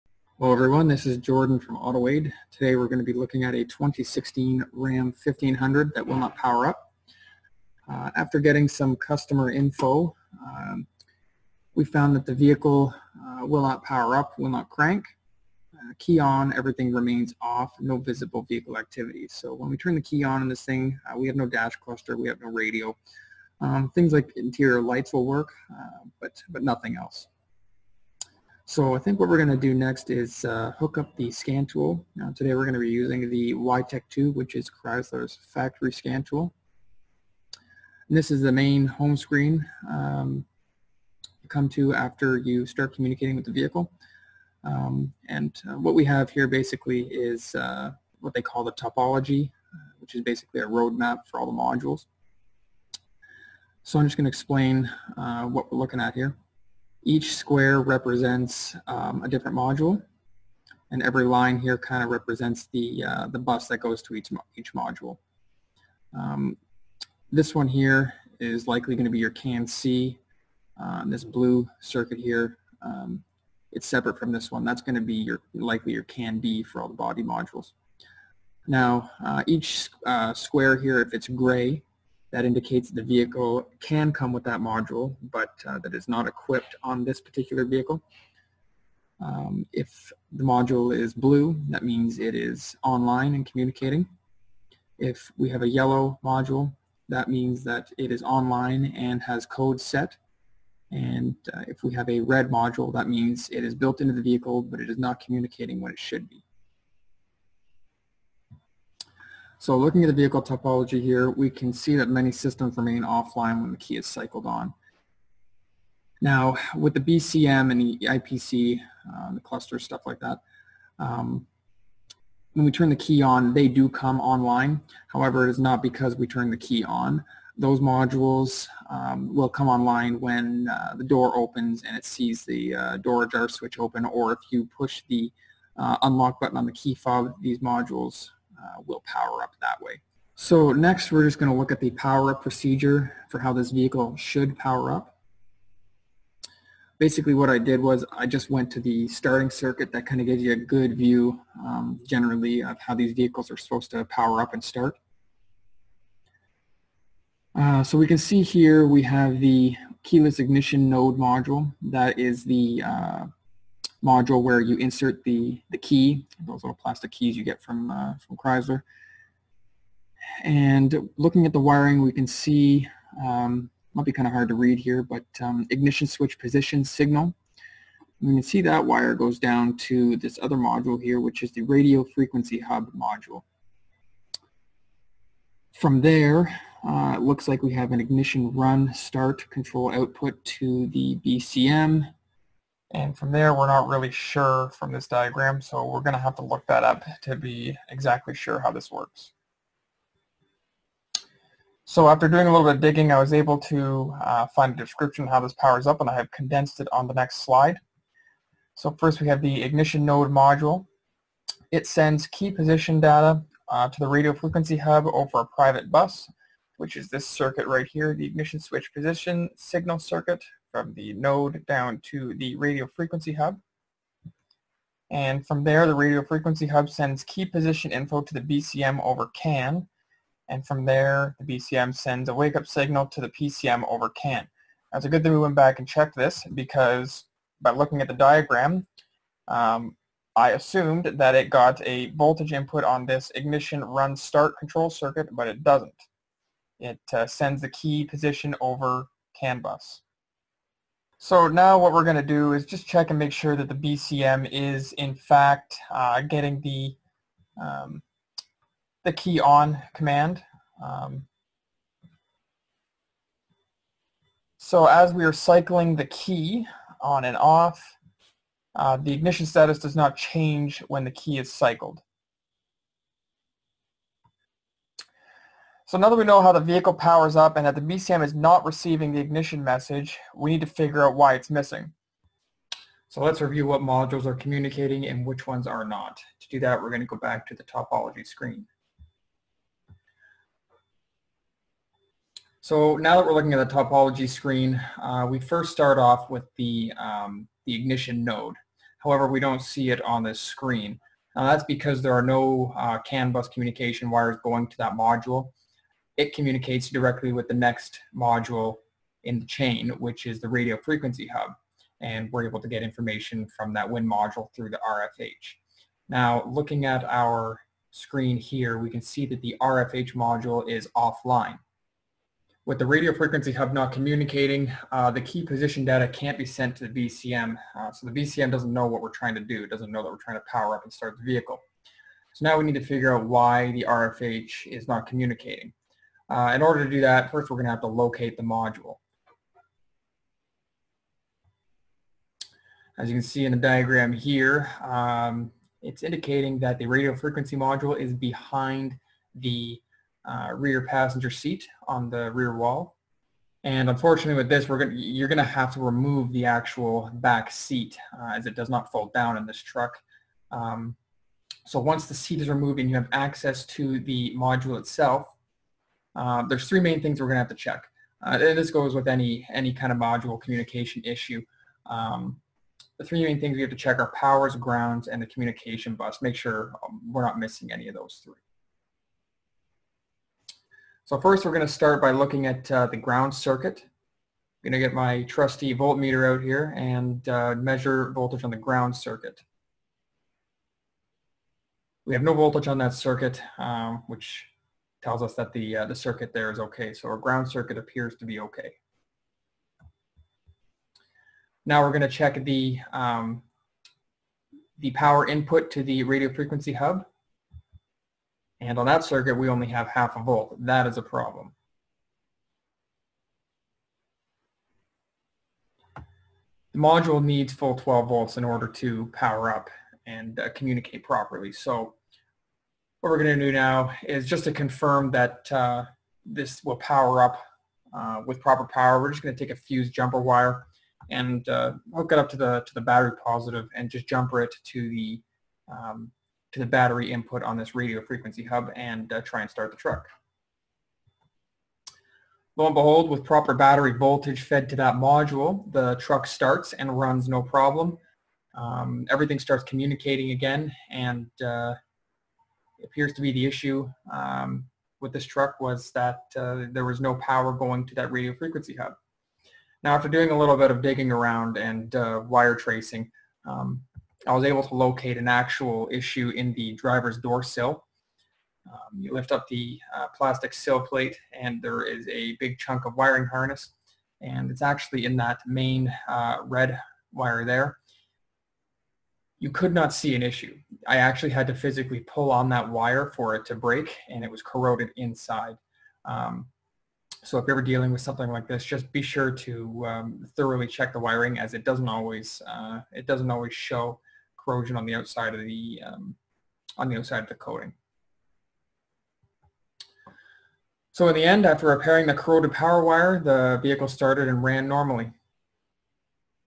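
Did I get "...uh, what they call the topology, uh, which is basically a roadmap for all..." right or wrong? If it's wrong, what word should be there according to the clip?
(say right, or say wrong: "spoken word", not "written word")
right.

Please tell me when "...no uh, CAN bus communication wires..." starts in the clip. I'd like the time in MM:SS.
05:02.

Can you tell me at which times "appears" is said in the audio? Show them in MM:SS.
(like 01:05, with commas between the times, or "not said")
06:37, 07:32.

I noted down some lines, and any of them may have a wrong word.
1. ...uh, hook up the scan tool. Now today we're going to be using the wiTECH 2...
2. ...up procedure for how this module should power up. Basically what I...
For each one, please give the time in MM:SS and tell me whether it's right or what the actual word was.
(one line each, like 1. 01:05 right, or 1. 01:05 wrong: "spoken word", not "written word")
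1. 00:30 right
2. 02:22 wrong: "vehicle", not "module".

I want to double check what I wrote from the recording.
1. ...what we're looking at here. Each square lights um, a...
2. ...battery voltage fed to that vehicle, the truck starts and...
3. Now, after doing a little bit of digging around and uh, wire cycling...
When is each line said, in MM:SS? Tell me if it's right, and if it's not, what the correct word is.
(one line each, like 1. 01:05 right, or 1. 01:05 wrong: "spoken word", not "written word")
1. 00:55 wrong: "represents", not "lights"
2. 07:23 wrong: "module", not "vehicle"
3. 07:39 wrong: "tracing", not "cycling".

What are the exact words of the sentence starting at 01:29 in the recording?
Um, if the module is blue, that means it is online and communicating.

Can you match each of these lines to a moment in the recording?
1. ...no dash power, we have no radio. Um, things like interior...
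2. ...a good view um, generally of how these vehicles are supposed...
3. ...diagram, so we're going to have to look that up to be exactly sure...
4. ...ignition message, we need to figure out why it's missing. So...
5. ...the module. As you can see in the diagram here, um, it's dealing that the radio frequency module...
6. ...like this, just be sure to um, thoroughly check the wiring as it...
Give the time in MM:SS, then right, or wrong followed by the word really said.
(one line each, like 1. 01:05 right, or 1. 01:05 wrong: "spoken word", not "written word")
1. 00:21 wrong: "cluster", not "power"
2. 02:30 right
3. 03:15 right
4. 04:39 right
5. 05:38 wrong: "indicating", not "dealing"
6. 08:08 right.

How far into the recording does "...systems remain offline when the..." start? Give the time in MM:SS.
01:52.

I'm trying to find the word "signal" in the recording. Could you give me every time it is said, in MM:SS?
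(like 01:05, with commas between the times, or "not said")
02:56, 03:39, 03:52.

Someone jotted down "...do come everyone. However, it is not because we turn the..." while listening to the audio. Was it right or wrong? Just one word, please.
wrong.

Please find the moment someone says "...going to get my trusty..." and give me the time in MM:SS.
06:24.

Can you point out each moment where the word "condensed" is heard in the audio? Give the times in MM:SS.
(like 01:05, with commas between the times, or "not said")
03:26.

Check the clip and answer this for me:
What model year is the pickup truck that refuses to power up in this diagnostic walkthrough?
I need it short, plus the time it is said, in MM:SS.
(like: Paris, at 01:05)
2016, at 00:03.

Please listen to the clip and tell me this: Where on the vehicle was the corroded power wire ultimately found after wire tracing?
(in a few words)
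driver's door sill.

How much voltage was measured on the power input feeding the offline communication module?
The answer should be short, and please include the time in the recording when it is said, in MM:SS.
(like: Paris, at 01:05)
0.5 volts, at 06:49.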